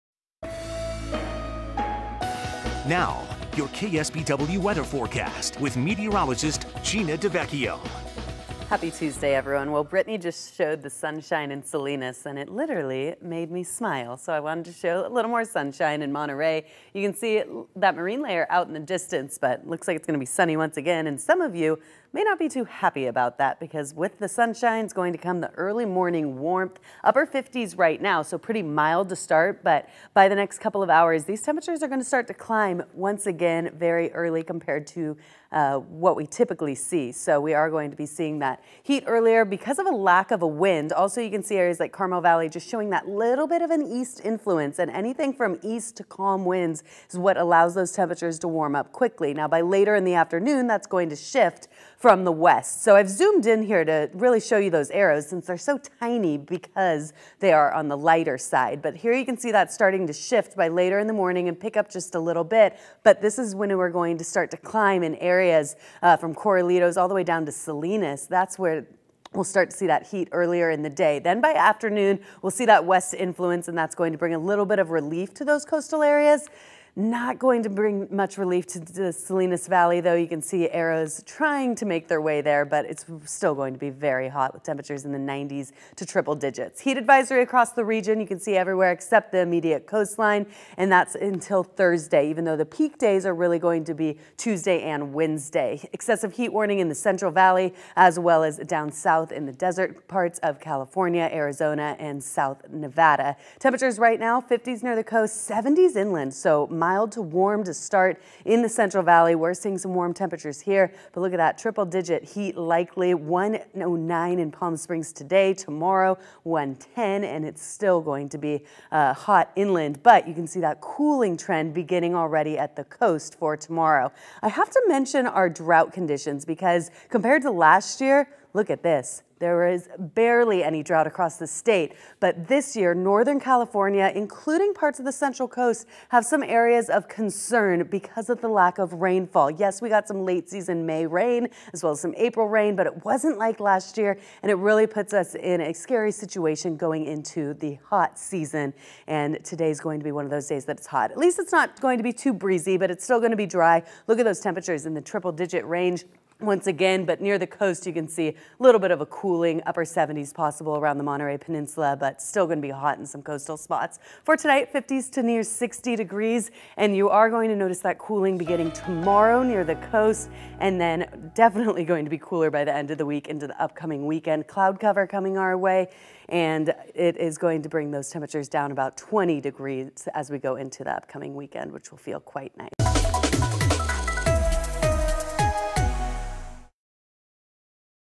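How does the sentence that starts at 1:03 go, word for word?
But this is when we're going to start to climb in areas uh, from Corralitos all the way down to Salinas.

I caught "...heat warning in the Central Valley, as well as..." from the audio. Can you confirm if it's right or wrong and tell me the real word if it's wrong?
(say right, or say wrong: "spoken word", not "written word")
right.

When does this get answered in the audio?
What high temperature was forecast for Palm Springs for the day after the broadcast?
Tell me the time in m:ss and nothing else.
1:56.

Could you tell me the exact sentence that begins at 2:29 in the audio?
And today's going to be one of those days that it's hot.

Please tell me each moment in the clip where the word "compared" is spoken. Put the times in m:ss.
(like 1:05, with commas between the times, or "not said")
0:34, 2:07.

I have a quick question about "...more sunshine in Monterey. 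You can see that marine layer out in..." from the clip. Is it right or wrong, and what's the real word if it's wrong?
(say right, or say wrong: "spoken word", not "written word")
right.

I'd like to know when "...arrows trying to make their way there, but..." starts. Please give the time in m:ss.
1:20.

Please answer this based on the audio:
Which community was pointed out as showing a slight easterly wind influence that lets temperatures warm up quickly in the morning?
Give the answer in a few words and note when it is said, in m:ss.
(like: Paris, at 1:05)
Carmel Valley, at 0:41.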